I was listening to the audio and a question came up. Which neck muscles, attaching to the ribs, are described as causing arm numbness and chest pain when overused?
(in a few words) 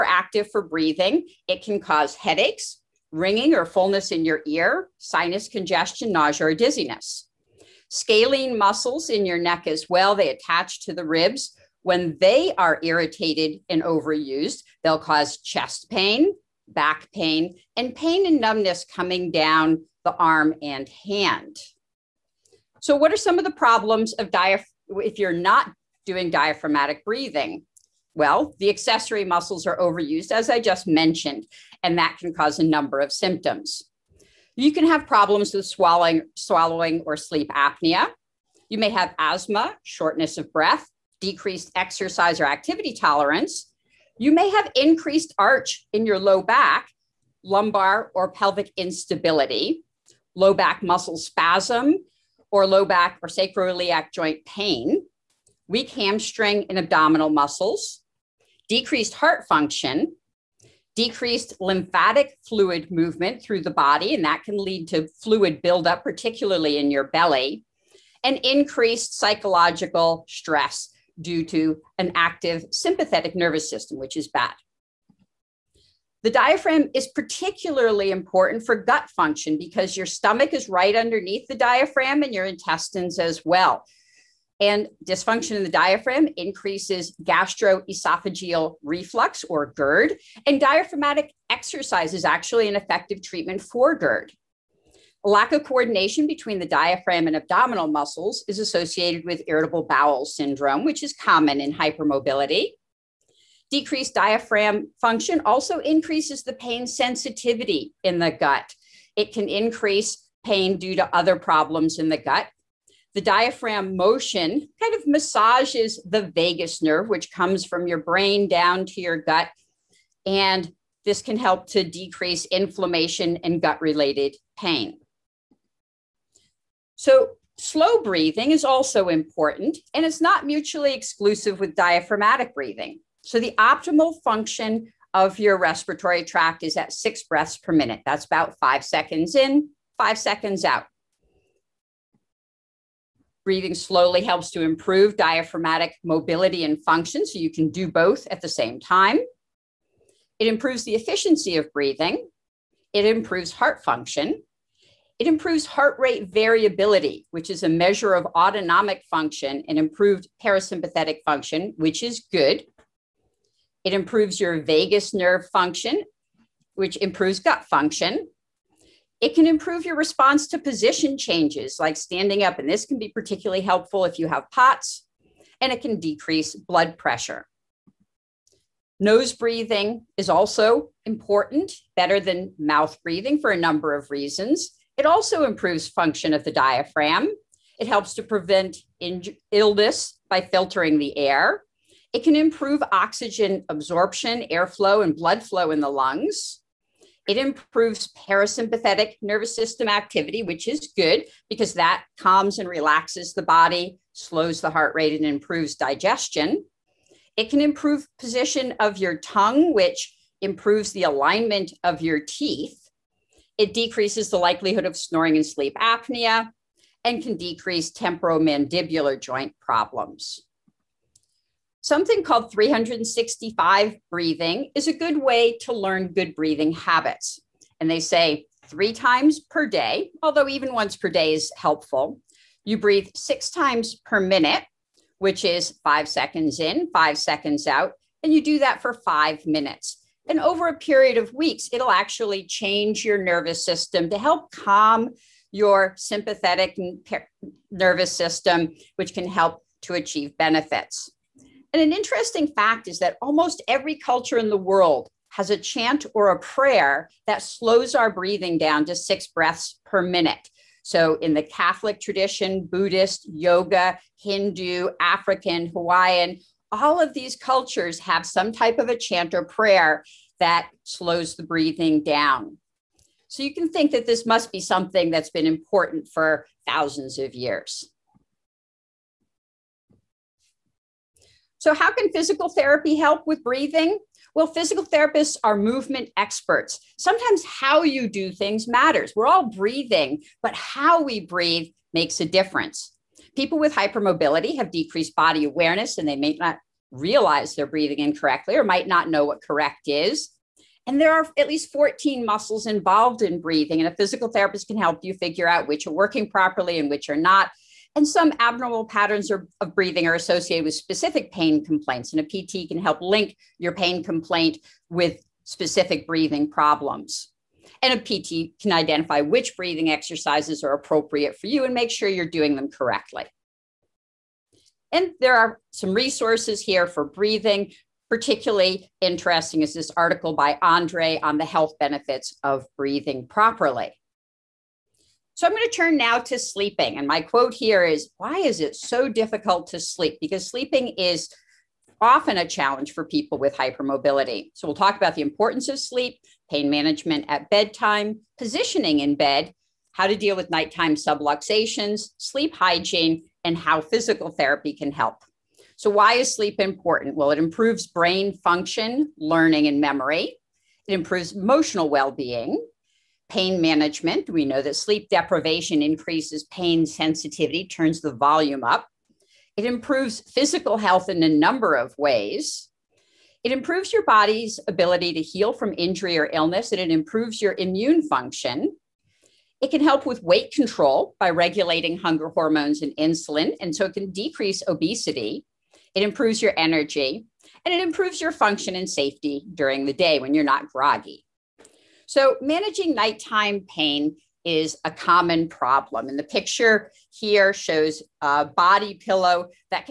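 Scalene muscles.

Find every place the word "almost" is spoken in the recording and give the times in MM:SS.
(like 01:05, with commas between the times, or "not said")
04:13.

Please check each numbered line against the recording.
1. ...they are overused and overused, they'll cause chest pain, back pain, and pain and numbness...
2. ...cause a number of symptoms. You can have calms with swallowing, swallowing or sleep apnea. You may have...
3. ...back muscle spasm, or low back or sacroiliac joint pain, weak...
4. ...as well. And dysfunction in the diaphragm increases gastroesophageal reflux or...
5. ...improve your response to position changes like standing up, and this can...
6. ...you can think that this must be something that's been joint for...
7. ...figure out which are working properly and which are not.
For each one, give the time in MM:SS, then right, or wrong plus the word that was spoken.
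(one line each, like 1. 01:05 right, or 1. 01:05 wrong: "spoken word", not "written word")
1. 00:12 wrong: "irritated", not "overused"
2. 00:32 wrong: "problems", not "calms"
3. 00:50 right
4. 01:23 right
5. 02:49 right
6. 04:33 wrong: "important", not "joint"
7. 05:05 right.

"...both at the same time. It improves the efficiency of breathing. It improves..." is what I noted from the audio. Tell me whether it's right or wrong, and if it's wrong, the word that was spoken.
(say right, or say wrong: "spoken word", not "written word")
right.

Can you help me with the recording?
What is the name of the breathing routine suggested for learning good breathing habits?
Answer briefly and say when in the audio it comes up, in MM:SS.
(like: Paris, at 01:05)
365 breathing, at 03:42.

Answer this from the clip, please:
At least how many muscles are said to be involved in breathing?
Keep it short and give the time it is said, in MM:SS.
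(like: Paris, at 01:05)
14, at 05:01.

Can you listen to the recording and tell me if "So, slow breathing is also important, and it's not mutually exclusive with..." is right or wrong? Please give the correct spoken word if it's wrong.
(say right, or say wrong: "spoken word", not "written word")
right.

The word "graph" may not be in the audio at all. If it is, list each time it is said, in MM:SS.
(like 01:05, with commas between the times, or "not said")
not said.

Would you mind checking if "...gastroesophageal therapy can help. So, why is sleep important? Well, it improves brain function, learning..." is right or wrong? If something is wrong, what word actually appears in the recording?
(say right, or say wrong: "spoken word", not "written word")
wrong: "physical", not "gastroesophageal".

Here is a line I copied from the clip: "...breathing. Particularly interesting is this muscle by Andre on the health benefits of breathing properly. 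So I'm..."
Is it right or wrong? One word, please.
wrong.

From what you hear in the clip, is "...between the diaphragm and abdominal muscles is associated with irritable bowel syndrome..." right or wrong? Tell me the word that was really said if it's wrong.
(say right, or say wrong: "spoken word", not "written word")
right.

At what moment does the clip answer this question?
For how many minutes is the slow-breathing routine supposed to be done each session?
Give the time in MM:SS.
03:58.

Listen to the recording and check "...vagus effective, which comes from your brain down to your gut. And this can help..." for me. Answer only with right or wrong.
wrong.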